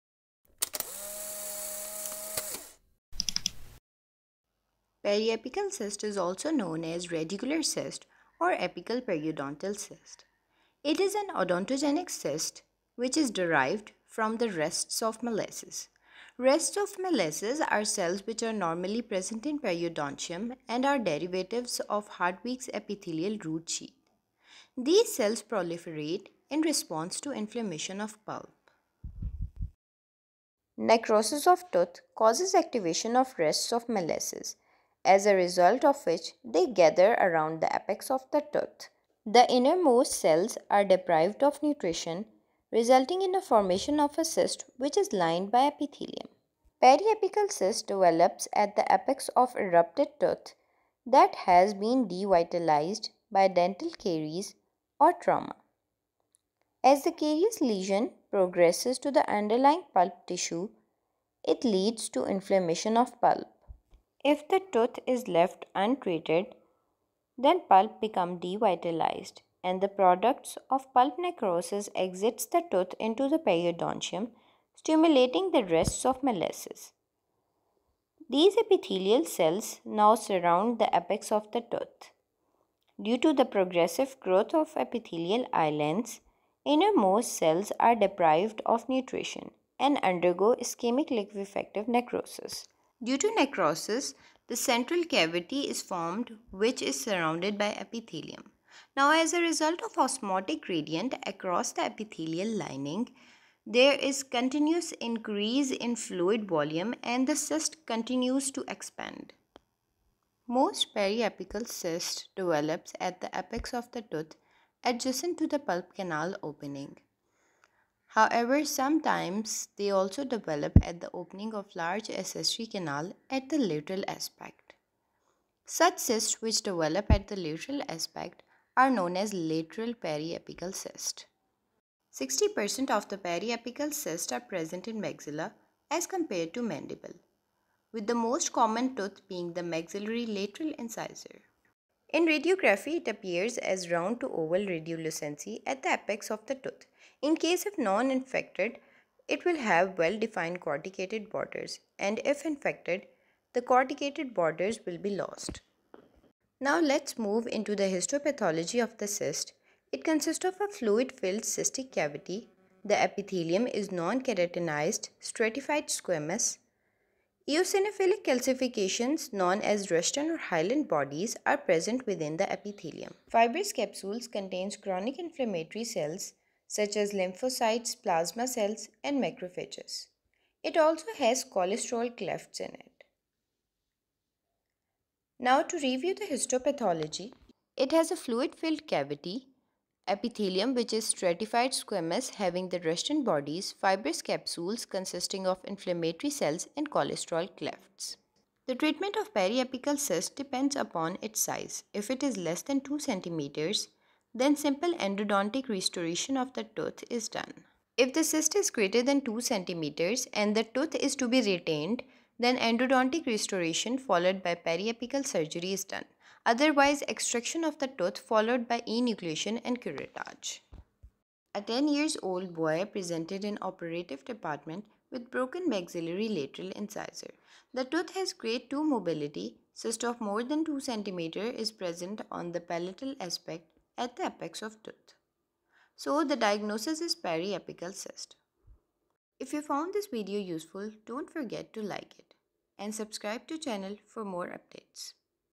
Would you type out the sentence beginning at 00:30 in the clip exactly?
Necrosis of tooth causes activation of rests of Malassez as a result of which they gather around the apex of the tooth.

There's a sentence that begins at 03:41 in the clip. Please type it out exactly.
A 10 years old boy presented in operative department with broken maxillary lateral incisor.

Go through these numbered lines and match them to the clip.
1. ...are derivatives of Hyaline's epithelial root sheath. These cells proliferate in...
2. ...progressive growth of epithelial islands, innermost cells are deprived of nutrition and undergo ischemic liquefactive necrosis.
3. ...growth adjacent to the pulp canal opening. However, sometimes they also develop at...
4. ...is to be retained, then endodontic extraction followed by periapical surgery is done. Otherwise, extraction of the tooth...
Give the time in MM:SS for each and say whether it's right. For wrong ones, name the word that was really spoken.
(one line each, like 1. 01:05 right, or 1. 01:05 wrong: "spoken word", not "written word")
1. 00:20 wrong: "Hertwig", not "Hyaline"
2. 01:23 right
3. 01:54 wrong: "tooth", not "growth"
4. 03:30 wrong: "restoration", not "extraction".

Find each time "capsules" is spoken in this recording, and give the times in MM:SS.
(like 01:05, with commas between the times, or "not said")
02:53, 03:14.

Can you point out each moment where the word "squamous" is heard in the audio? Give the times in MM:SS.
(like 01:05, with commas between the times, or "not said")
02:45, 03:11.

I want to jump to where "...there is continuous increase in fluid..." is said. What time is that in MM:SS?
01:43.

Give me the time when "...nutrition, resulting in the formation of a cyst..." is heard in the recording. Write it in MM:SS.
00:41.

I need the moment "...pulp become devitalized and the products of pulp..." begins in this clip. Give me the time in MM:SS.
01:07.